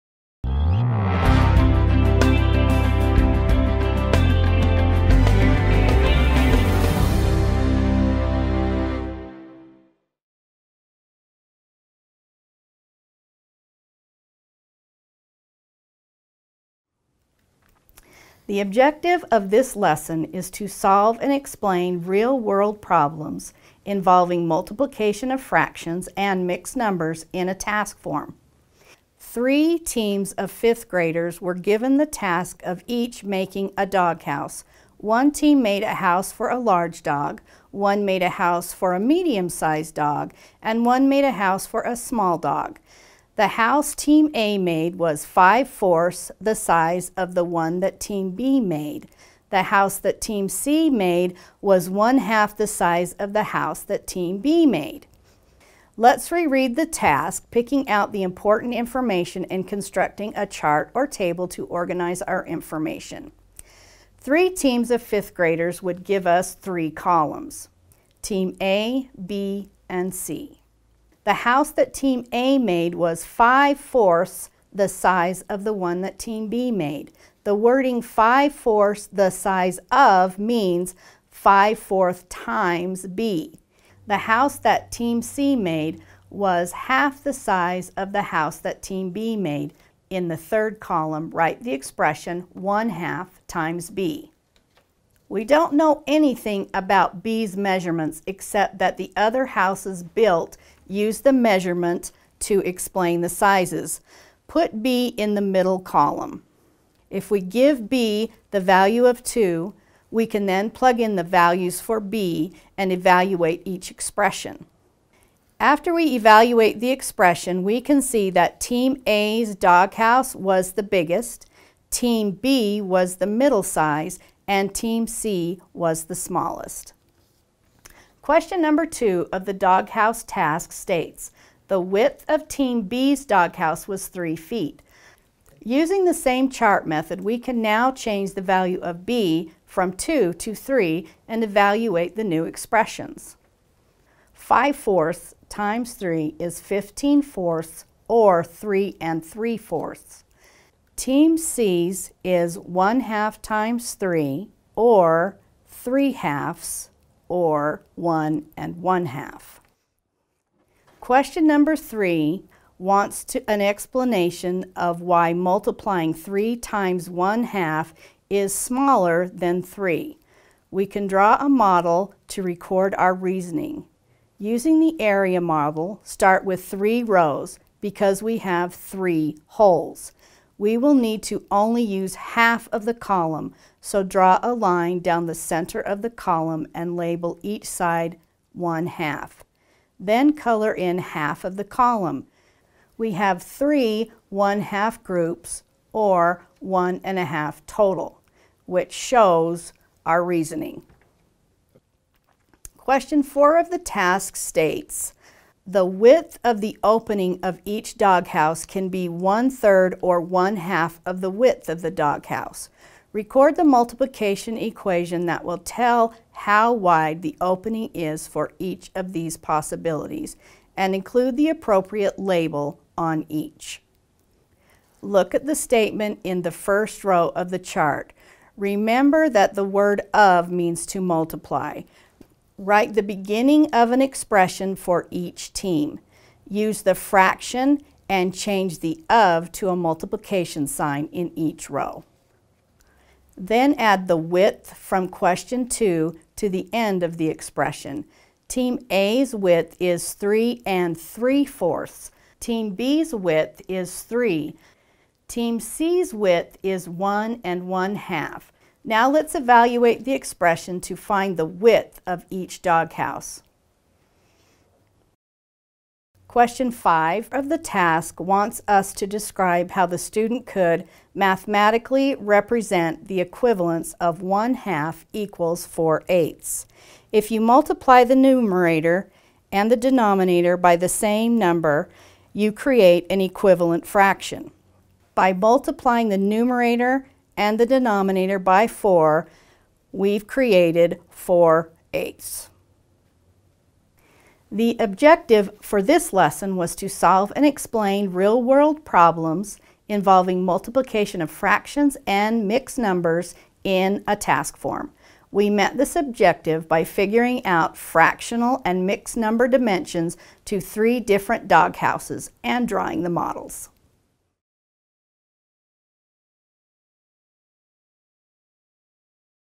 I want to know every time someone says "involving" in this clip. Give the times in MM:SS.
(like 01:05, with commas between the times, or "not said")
00:23, 04:59.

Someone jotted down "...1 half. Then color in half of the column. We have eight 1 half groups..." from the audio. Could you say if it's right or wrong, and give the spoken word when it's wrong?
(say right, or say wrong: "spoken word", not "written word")
wrong: "three", not "eight".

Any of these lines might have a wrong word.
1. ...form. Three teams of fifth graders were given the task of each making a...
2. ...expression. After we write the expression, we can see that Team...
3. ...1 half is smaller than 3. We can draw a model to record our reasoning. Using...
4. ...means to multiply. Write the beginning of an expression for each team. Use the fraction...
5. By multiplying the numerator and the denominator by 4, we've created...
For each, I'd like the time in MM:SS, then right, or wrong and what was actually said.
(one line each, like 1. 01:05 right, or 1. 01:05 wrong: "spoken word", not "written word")
1. 00:27 right
2. 01:53 wrong: "evaluate", not "write"
3. 02:47 right
4. 03:50 right
5. 04:45 right.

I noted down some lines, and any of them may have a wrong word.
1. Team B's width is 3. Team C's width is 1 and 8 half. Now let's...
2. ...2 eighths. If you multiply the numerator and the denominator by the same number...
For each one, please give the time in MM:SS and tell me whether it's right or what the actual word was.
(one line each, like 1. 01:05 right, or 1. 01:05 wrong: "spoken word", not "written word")
1. 04:12 wrong: "1", not "8"
2. 04:35 wrong: "4", not "2".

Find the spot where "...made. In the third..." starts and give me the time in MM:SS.
01:29.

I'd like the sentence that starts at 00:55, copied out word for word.
Let's reread the task, picking out the important information and constructing a chart or table to organize our information.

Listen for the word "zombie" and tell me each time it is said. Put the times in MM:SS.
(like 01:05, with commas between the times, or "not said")
not said.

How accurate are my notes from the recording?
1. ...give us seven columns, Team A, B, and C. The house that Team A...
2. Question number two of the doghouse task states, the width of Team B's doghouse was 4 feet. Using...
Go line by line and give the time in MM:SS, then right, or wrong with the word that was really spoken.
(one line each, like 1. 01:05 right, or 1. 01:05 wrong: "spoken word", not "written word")
1. 01:06 wrong: "three", not "seven"
2. 02:08 wrong: "3", not "4".